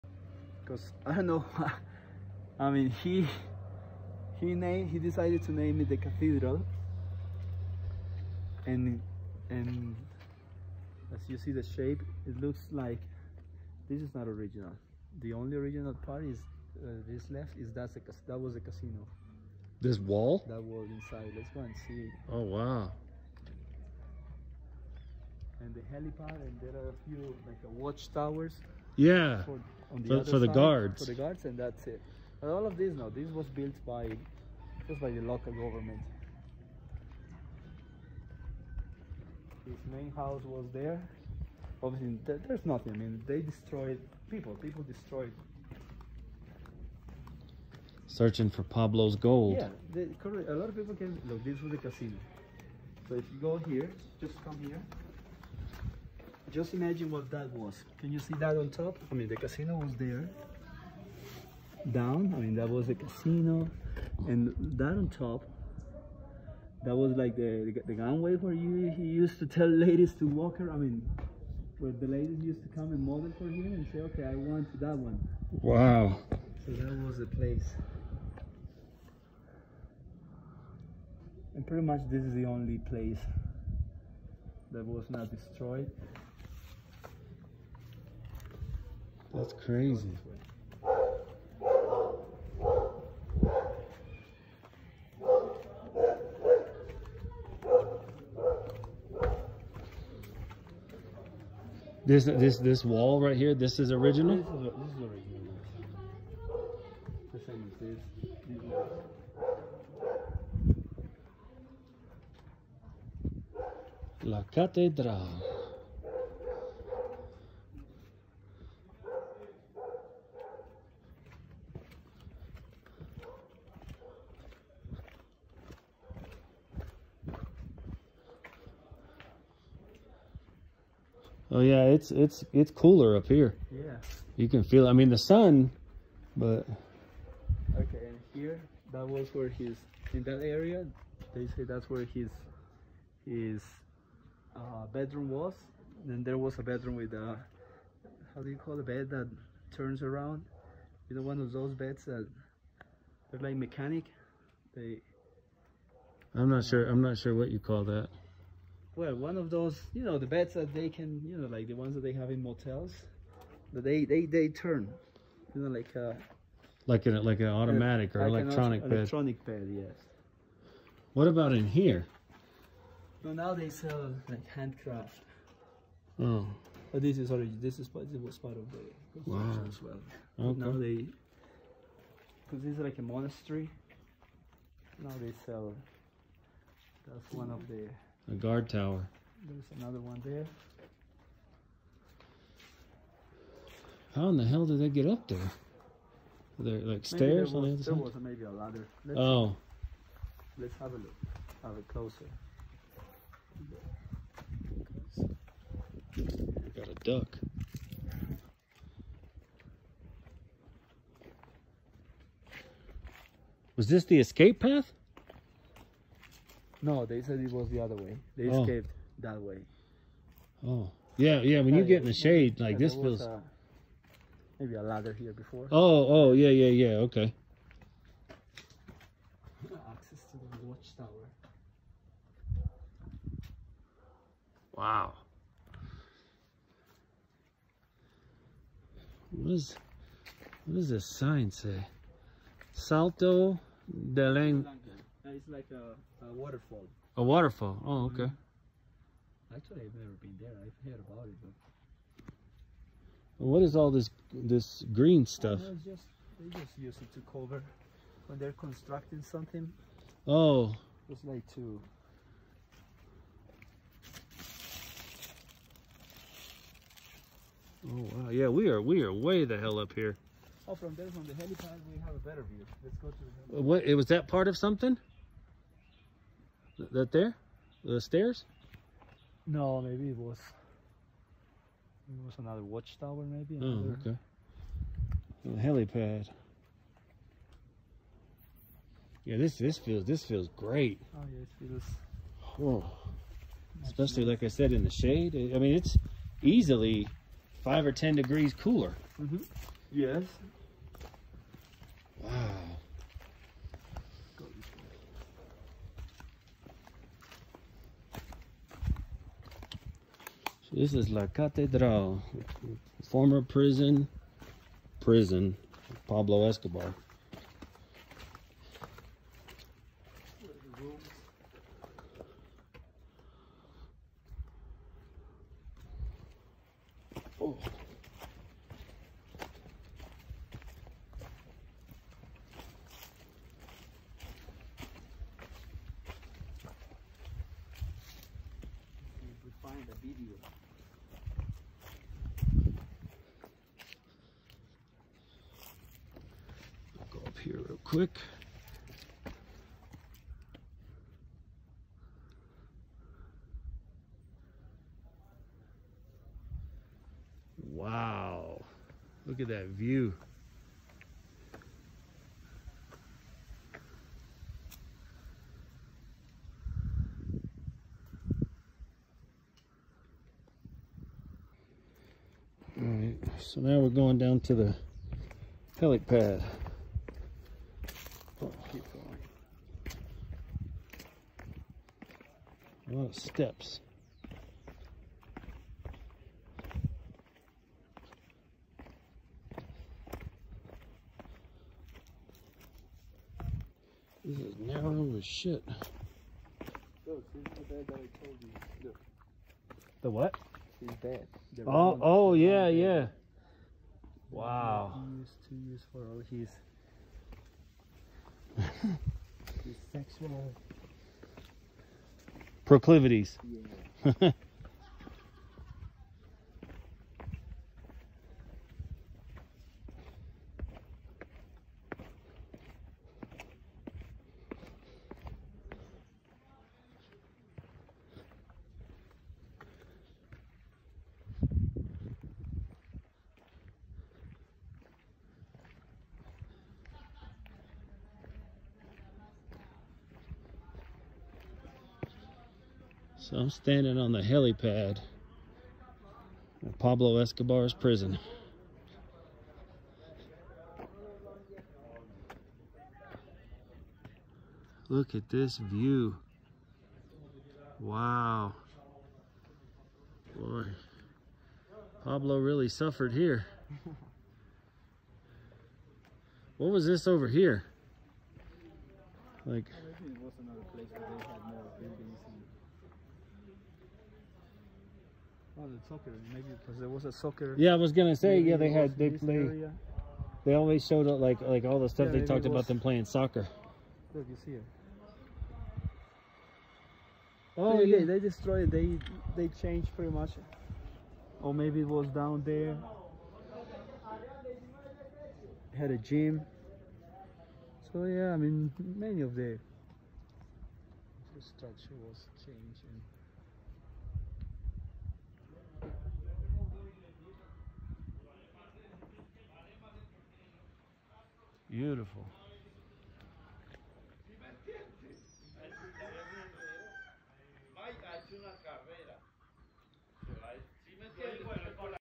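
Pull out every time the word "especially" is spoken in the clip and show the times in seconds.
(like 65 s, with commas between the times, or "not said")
293 s.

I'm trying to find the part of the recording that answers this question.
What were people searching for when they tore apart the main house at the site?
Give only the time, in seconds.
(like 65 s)
48 s.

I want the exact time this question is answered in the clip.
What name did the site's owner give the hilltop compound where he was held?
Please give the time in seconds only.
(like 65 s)
5 s.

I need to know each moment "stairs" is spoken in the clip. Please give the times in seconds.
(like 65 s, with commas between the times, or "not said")
197 s, 278 s.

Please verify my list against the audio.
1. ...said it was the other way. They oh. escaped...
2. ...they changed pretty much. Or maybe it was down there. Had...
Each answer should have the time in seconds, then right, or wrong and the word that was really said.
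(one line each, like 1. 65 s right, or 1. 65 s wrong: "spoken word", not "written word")
1. 217 s right
2. 489 s right.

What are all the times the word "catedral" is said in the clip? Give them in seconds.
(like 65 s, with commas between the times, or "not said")
114 s, 311 s.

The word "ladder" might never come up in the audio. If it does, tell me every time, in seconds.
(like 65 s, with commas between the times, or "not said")
198 s, 224 s.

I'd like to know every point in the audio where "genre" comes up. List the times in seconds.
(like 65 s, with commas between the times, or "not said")
not said.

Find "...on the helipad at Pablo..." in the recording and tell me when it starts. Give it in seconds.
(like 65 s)
443 s.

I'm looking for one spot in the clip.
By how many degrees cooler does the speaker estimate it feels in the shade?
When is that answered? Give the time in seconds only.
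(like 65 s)
297 s.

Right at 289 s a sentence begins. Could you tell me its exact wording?
Yeah, this this feels this feels great.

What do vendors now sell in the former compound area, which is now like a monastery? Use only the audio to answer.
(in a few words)
Handcraft.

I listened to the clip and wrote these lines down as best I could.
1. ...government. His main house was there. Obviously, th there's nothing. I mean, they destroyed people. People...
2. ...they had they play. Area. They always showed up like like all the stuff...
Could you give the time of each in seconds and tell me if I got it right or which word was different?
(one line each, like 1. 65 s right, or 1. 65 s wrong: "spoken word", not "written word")
1. 35 s right
2. 478 s right.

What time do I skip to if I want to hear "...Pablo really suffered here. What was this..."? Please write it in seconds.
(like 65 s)
462 s.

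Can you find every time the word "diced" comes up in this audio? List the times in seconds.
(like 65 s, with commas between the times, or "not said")
not said.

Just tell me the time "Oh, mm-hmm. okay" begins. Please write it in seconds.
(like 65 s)
247 s.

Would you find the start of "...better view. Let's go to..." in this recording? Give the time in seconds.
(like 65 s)
272 s.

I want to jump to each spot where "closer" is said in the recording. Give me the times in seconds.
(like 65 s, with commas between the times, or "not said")
201 s.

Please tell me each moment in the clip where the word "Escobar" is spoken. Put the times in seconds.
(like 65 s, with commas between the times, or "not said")
316 s, 447 s.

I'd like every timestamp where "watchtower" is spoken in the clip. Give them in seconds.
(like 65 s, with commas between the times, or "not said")
27 s, 230 s, 282 s.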